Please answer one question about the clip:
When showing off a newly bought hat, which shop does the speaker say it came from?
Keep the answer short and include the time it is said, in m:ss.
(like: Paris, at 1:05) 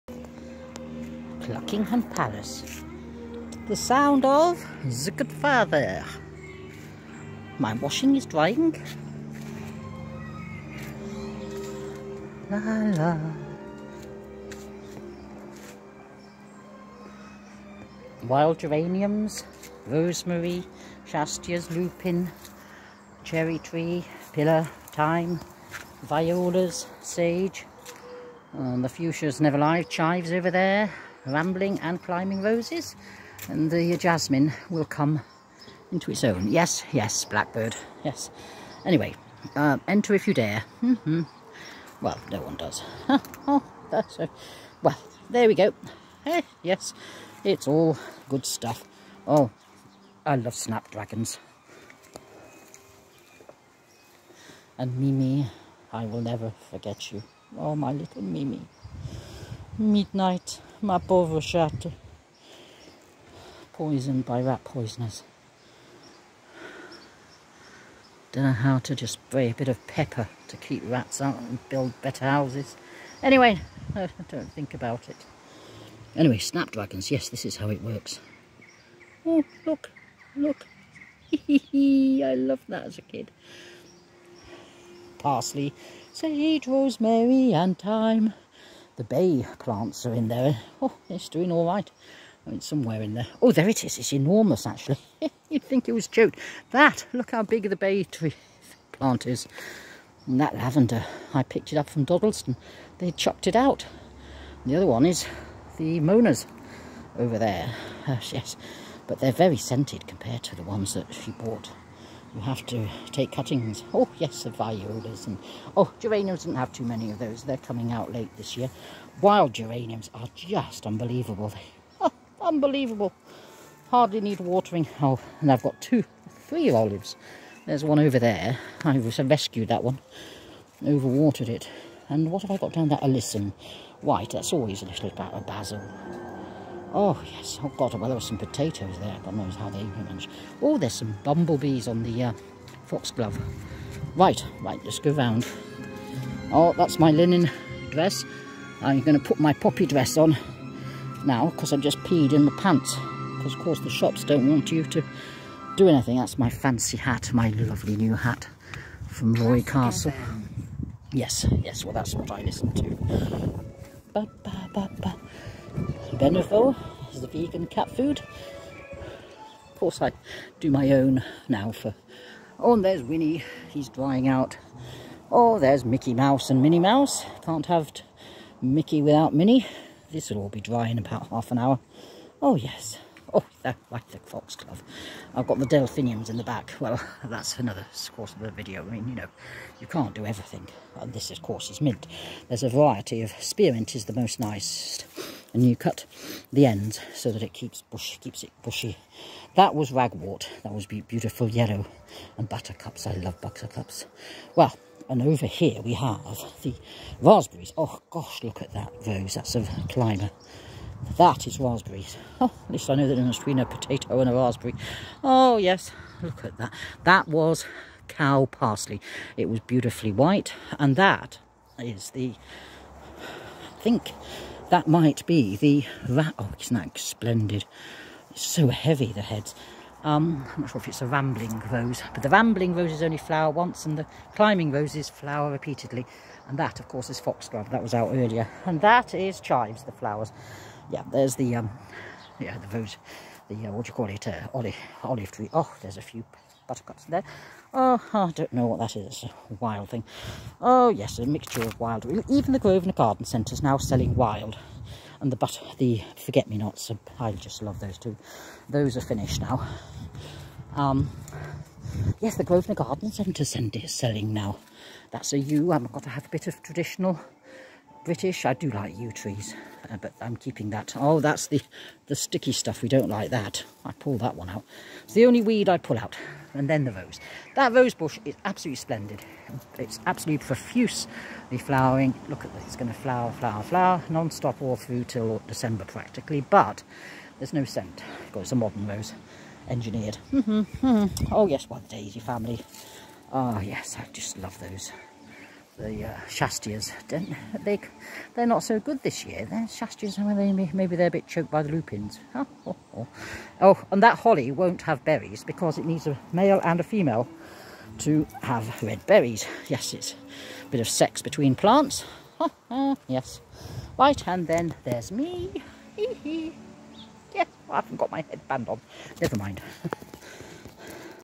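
Roy Castle, at 2:39.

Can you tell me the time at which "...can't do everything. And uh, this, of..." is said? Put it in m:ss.
3:09.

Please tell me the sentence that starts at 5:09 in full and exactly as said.
Yes, it's a bit of sex between plants.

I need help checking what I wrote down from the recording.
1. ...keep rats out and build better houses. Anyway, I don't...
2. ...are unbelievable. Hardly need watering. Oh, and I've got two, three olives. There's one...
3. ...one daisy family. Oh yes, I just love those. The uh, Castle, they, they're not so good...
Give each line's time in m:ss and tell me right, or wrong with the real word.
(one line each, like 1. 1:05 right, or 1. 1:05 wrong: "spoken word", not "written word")
1. 1:10 right
2. 2:02 right
3. 4:51 wrong: "Shastias", not "Castle".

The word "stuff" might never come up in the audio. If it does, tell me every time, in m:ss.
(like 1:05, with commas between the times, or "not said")
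0:48, 4:32.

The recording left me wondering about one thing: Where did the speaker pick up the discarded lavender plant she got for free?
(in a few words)
Dodleston.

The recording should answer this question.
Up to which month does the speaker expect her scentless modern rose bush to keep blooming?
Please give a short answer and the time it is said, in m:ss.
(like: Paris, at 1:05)
December, at 4:45.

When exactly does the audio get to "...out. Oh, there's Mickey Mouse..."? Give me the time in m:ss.
2:54.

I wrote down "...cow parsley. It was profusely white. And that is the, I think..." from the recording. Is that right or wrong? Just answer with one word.
wrong.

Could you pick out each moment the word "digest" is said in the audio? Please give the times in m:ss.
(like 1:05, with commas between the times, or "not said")
not said.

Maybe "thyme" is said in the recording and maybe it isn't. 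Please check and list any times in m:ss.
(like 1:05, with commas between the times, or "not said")
0:24, 1:27.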